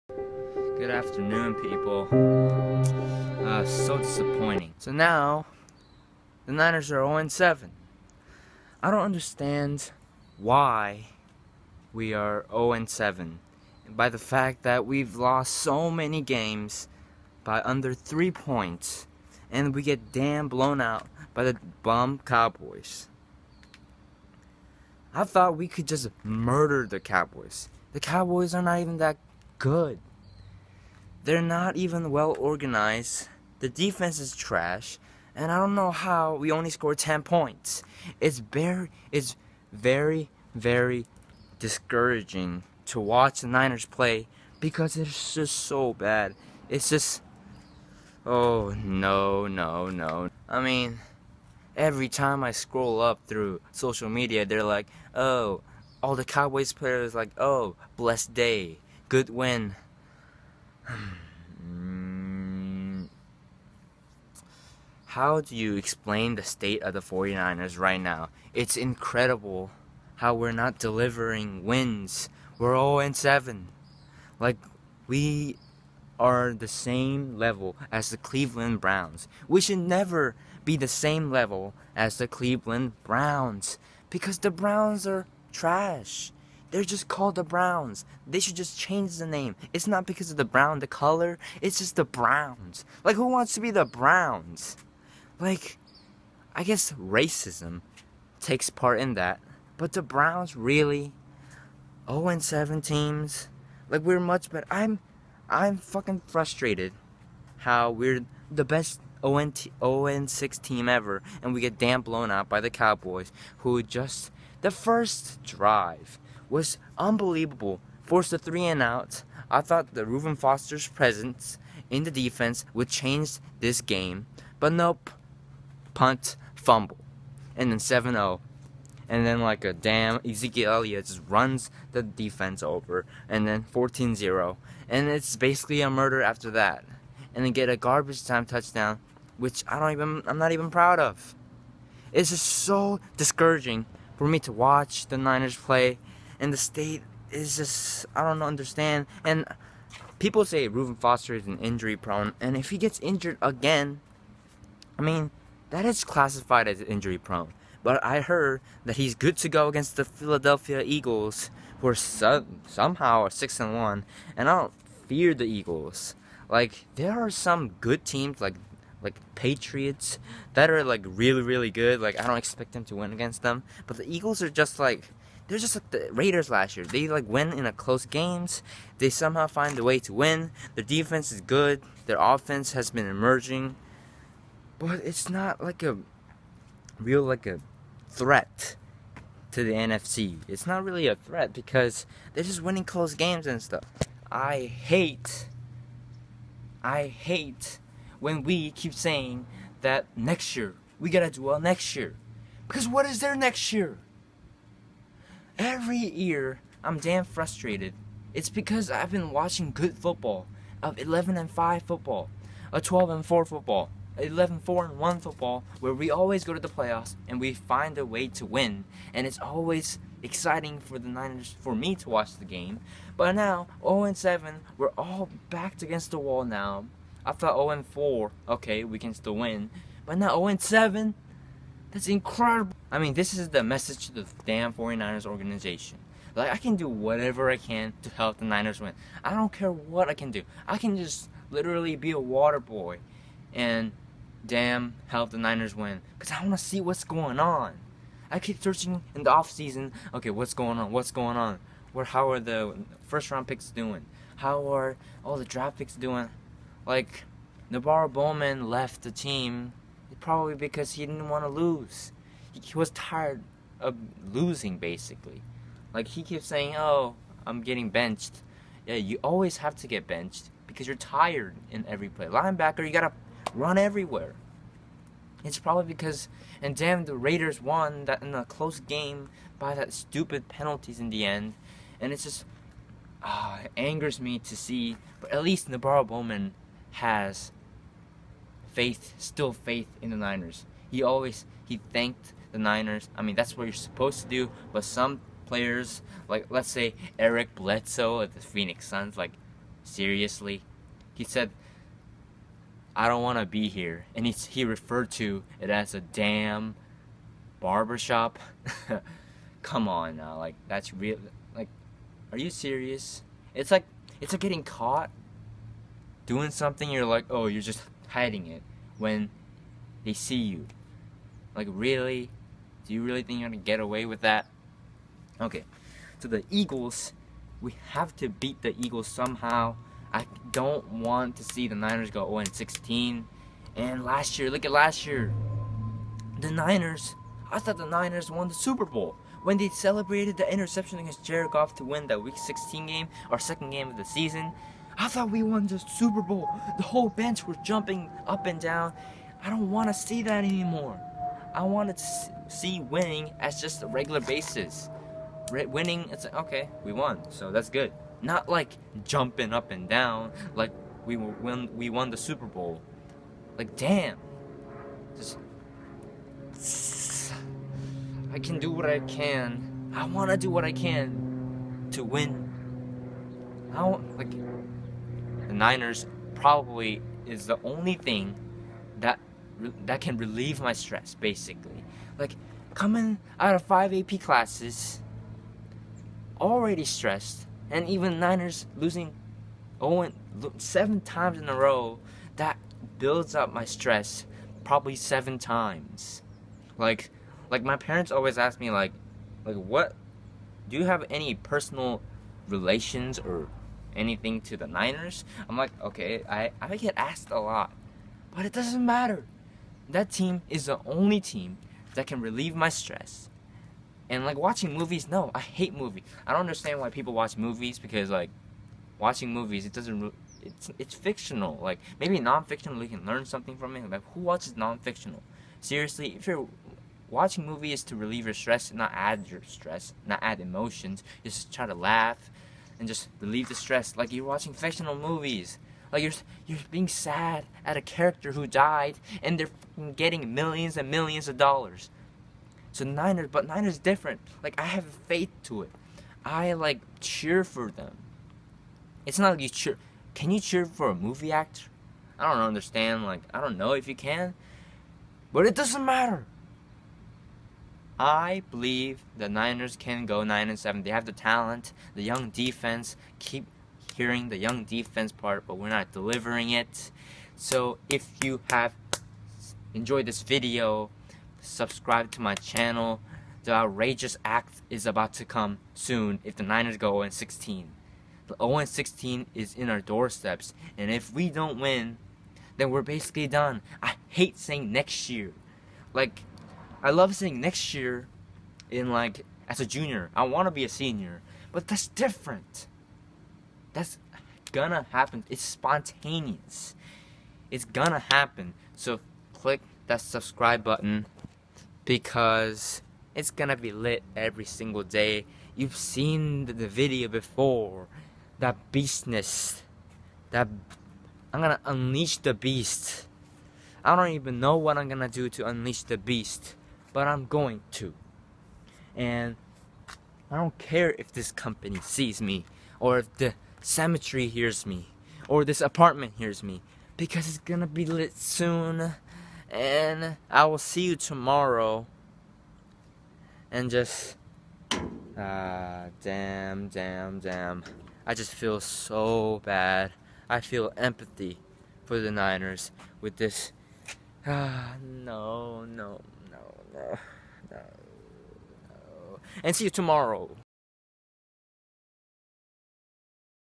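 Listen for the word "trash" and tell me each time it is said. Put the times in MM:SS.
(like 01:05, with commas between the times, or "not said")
00:34, 01:25.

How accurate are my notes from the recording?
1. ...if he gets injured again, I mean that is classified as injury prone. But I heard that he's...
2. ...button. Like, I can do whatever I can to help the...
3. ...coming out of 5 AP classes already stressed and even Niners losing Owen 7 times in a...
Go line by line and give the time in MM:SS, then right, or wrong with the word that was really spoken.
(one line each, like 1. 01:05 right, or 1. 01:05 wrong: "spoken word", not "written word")
1. 02:32 right
2. 03:55 wrong: "organization", not "button"
3. 06:22 right.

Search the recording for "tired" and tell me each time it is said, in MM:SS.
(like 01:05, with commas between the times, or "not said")
04:22, 04:30.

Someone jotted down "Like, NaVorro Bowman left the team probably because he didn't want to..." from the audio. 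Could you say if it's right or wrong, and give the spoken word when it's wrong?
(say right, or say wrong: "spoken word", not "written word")
right.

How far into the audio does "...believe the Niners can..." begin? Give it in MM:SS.
07:38.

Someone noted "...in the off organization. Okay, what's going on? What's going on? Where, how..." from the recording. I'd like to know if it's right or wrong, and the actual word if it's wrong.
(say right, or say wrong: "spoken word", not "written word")
wrong: "season", not "organization".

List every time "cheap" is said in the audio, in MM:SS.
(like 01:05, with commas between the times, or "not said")
not said.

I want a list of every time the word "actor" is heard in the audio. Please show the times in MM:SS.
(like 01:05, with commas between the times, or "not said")
07:31.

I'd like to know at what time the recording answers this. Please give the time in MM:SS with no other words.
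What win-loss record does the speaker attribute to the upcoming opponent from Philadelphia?
02:43.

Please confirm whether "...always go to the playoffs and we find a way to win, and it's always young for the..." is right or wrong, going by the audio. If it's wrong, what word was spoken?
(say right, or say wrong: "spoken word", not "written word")
wrong: "exciting", not "young".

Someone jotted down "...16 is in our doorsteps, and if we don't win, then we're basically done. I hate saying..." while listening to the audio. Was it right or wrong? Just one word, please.
right.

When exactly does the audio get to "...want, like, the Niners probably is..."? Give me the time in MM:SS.
06:13.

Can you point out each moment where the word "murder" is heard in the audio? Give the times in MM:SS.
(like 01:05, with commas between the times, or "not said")
00:26, 02:15.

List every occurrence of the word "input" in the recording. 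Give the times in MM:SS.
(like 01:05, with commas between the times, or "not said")
not said.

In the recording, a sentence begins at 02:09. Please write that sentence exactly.
And then like a damn Ezekiel Elliott just runs the defense over, and then 14-0.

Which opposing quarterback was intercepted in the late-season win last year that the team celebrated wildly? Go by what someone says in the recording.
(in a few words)
Jared Goff.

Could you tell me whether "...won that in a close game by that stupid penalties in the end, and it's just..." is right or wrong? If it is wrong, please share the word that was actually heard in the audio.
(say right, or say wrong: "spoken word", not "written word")
right.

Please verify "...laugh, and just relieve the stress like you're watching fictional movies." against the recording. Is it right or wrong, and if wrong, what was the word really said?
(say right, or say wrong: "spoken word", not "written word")
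right.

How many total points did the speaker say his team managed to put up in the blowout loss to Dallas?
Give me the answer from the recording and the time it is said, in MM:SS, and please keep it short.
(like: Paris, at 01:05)
10, at 00:36.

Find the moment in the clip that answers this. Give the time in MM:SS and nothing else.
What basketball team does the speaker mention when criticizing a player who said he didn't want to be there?
04:58.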